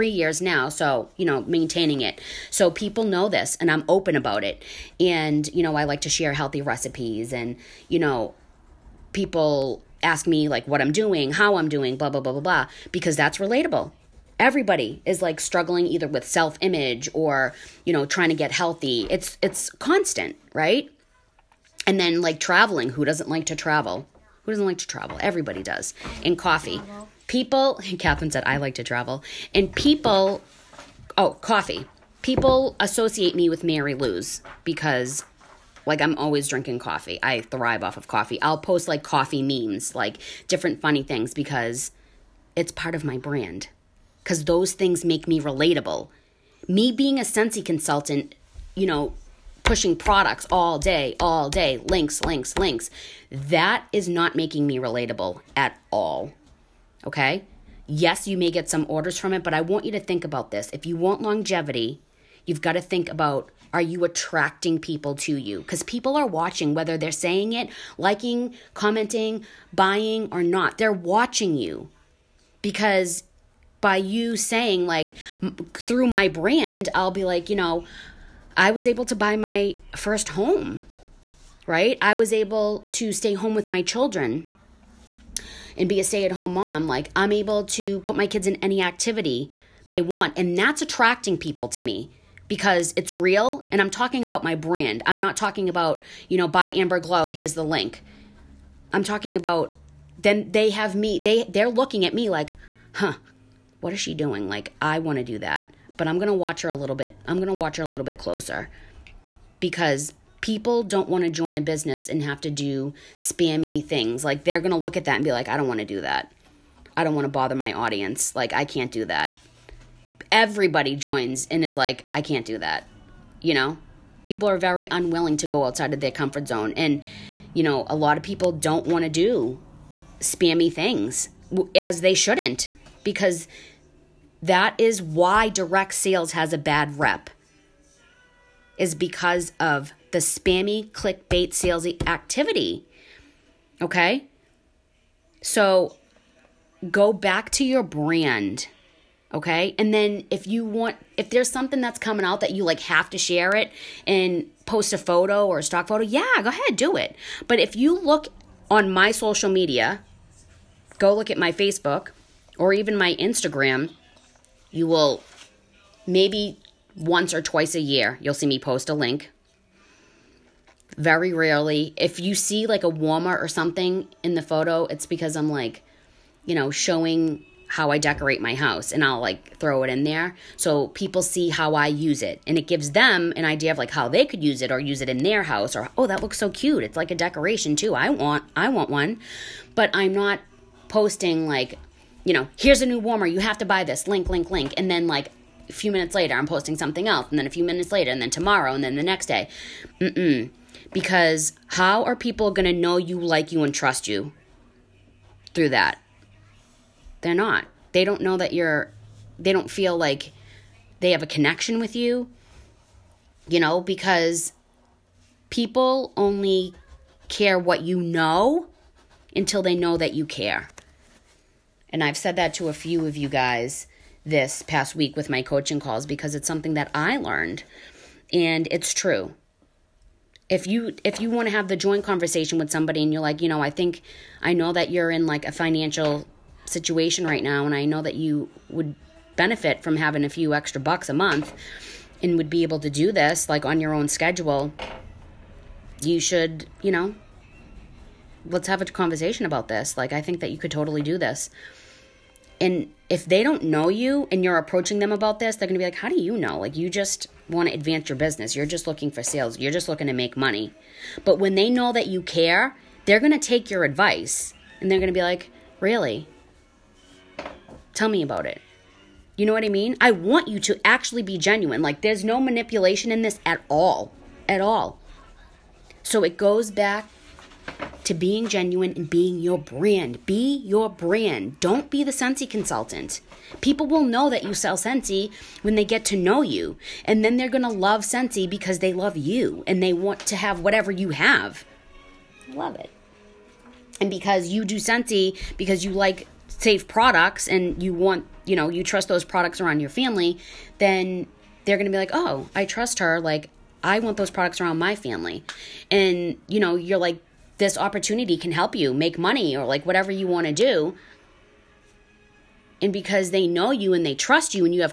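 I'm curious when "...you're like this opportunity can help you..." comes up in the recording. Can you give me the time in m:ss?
5:06.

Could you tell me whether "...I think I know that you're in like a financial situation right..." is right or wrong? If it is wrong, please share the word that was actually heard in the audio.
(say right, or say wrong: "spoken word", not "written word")
right.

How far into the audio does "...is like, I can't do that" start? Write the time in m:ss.
2:01.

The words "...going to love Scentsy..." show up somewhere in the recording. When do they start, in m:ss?
4:47.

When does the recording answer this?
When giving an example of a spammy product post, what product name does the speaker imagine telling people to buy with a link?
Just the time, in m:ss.
1:36.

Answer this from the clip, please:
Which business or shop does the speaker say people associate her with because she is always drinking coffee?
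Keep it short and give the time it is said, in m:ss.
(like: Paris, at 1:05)
Mary Lou's, at 0:33.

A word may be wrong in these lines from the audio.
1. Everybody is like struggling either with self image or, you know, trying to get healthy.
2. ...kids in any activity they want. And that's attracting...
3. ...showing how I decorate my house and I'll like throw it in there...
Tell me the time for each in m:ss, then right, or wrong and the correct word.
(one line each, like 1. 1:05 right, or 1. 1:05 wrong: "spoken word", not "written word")
1. 0:14 right
2. 1:28 right
3. 2:56 right.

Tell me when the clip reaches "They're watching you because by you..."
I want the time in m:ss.
1:10.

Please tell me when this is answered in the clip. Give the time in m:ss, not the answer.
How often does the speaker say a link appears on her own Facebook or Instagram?
2:46.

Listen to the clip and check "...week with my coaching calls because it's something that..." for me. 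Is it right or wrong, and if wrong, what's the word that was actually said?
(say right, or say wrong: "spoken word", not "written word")
right.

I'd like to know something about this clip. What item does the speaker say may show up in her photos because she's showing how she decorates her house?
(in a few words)
a warmer.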